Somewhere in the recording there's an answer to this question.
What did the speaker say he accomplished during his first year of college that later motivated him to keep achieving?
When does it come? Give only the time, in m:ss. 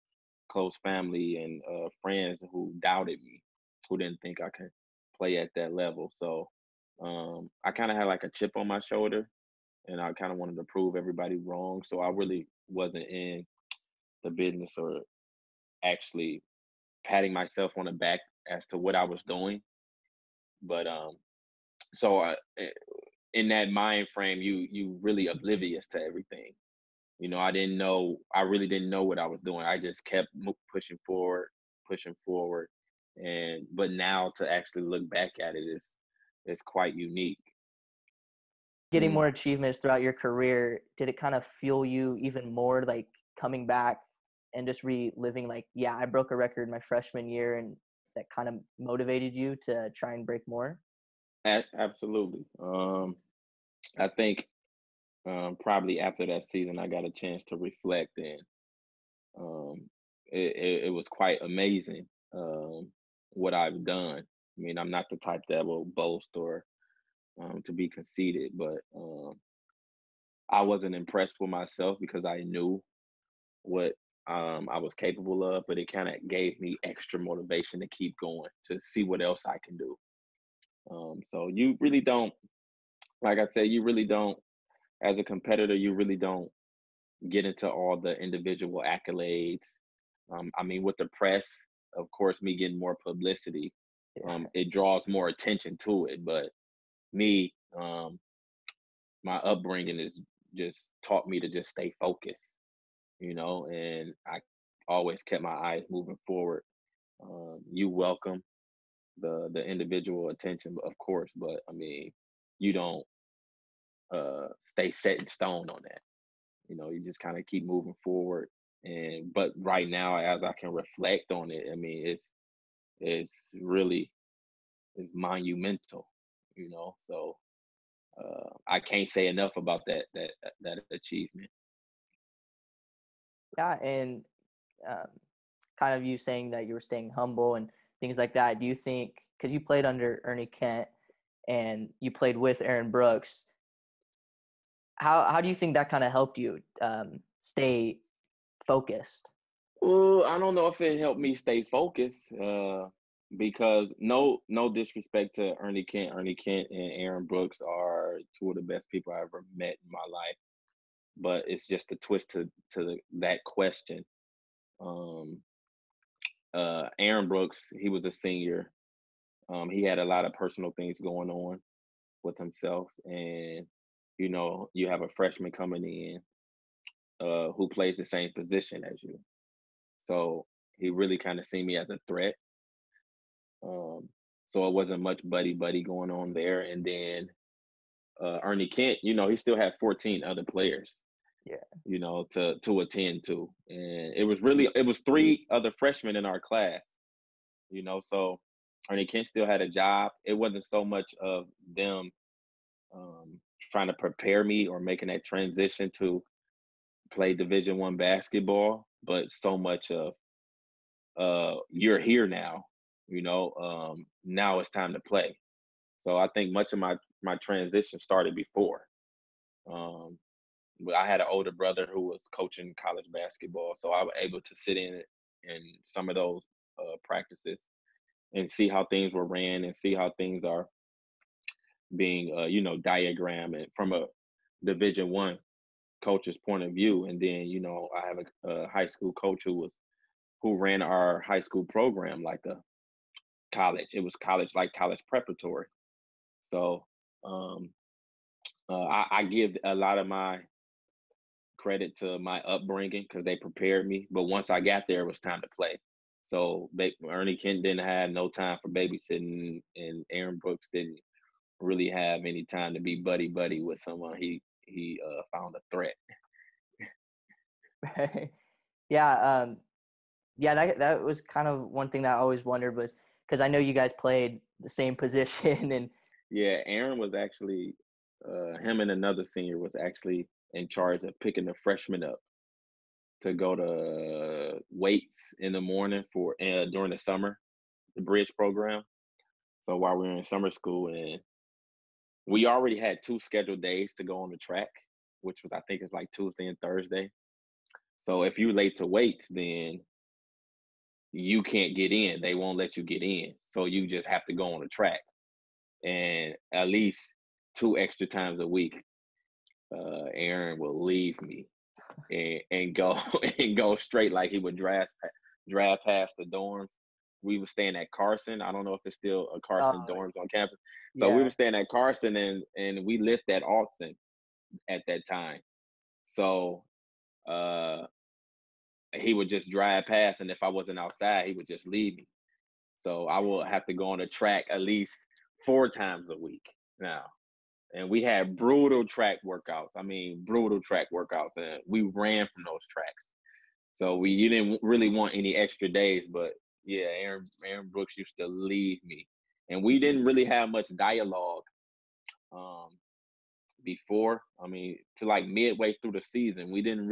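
0:45.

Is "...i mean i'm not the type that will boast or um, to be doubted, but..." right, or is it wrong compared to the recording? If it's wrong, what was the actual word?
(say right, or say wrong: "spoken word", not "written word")
wrong: "conceited", not "doubted".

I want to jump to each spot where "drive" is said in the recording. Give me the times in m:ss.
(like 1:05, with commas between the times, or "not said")
5:15, 5:29.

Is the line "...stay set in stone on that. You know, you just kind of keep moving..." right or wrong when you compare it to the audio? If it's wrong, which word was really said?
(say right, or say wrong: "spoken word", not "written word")
right.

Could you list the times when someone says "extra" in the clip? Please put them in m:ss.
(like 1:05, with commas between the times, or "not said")
1:16, 5:07, 5:45.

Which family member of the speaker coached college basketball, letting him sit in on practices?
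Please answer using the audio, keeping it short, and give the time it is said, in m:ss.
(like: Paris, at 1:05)
Older brother, at 3:41.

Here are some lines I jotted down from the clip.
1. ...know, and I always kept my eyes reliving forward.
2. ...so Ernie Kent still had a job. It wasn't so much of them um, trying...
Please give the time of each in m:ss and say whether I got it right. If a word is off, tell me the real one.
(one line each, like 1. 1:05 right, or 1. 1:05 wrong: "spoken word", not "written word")
1. 1:43 wrong: "moving", not "reliving"
2. 3:18 right.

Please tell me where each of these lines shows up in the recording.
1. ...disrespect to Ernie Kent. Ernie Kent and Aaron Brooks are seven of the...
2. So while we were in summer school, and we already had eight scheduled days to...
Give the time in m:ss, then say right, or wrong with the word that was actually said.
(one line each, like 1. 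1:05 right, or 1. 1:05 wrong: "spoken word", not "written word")
1. 2:34 wrong: "two", not "seven"
2. 4:49 wrong: "two", not "eight".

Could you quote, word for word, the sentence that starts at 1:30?
Um, I mean, with the press, of course, me getting more publicity, um, it draws more attention to it.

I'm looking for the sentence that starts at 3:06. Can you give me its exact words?
And then uh, Ernie Kent, you know, he still had 14 other players.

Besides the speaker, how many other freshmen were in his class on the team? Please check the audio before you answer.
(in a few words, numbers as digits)
3.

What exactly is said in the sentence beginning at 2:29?
Well, I don't know if it helped me stay focused.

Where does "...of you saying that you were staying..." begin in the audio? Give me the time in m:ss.
2:15.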